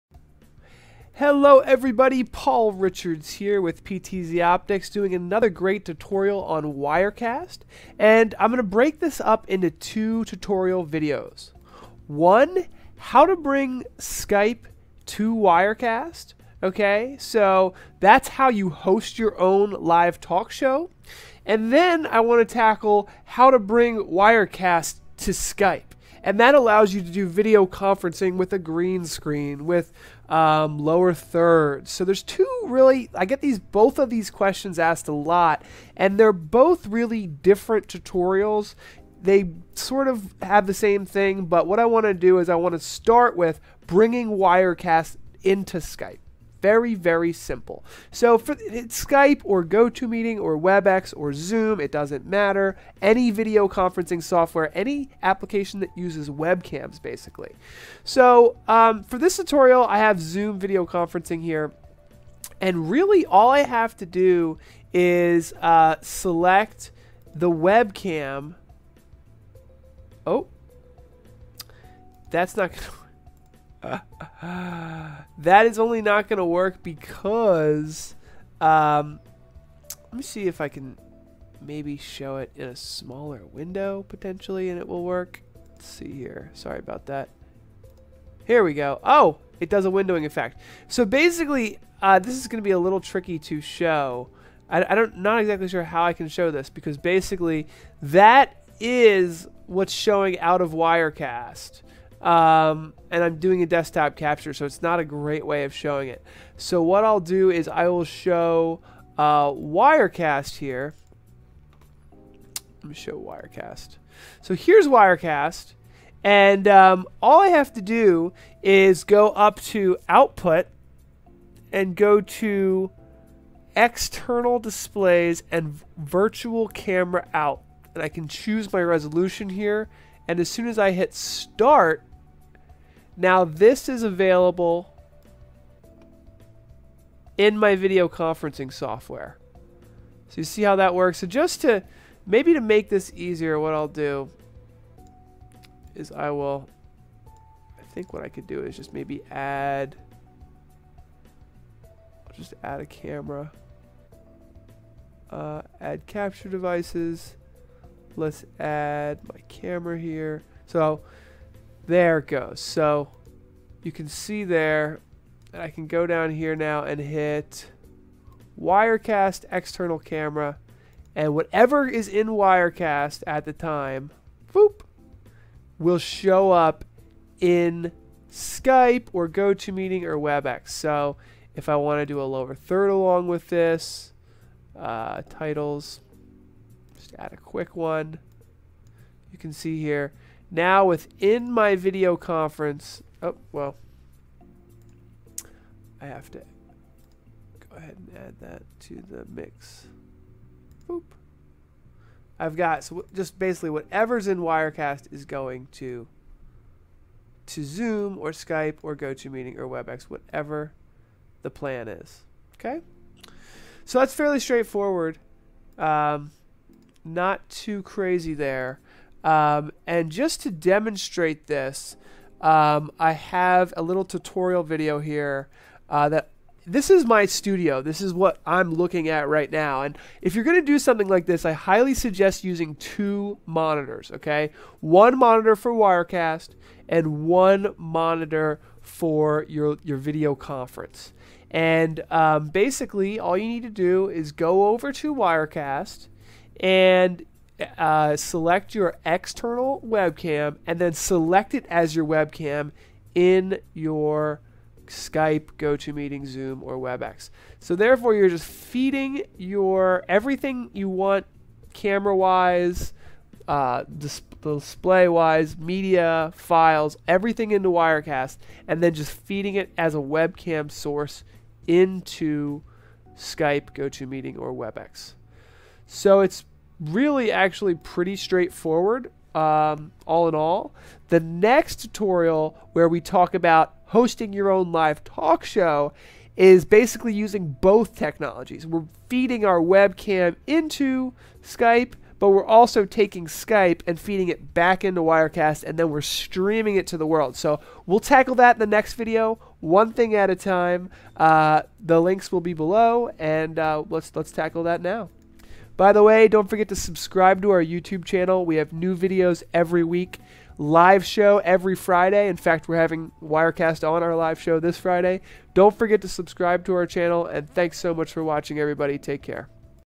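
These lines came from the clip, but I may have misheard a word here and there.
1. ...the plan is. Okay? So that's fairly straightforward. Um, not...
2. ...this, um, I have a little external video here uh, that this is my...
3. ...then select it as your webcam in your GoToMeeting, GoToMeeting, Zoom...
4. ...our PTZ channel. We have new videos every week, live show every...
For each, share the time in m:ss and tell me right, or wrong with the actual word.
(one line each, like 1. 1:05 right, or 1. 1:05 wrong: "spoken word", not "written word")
1. 3:31 right
2. 3:41 wrong: "tutorial", not "external"
3. 4:10 wrong: "Skype", not "GoToMeeting"
4. 5:07 wrong: "YouTube", not "PTZ".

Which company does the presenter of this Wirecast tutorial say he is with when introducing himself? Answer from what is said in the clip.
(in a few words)
PTZ Optics.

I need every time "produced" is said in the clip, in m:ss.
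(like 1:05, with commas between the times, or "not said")
not said.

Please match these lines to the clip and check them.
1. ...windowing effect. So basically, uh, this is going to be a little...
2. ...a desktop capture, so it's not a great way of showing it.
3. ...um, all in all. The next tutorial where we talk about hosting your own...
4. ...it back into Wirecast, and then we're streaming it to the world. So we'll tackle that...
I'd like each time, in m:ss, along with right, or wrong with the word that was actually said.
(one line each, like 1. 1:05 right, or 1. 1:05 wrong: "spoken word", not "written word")
1. 1:29 right
2. 1:43 right
3. 4:39 right
4. 4:54 right.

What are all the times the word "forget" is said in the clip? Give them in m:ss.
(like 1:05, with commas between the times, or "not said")
5:06, 5:15.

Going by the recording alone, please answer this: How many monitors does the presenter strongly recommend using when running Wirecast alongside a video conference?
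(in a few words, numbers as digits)
2.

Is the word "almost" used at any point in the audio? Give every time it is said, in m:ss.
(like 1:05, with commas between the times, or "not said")
not said.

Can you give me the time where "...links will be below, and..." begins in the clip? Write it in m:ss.
5:02.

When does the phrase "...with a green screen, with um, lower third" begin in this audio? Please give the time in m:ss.
0:28.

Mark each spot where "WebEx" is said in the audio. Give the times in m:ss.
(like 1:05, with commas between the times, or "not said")
0:50, 3:00, 3:29, 4:16, 4:34.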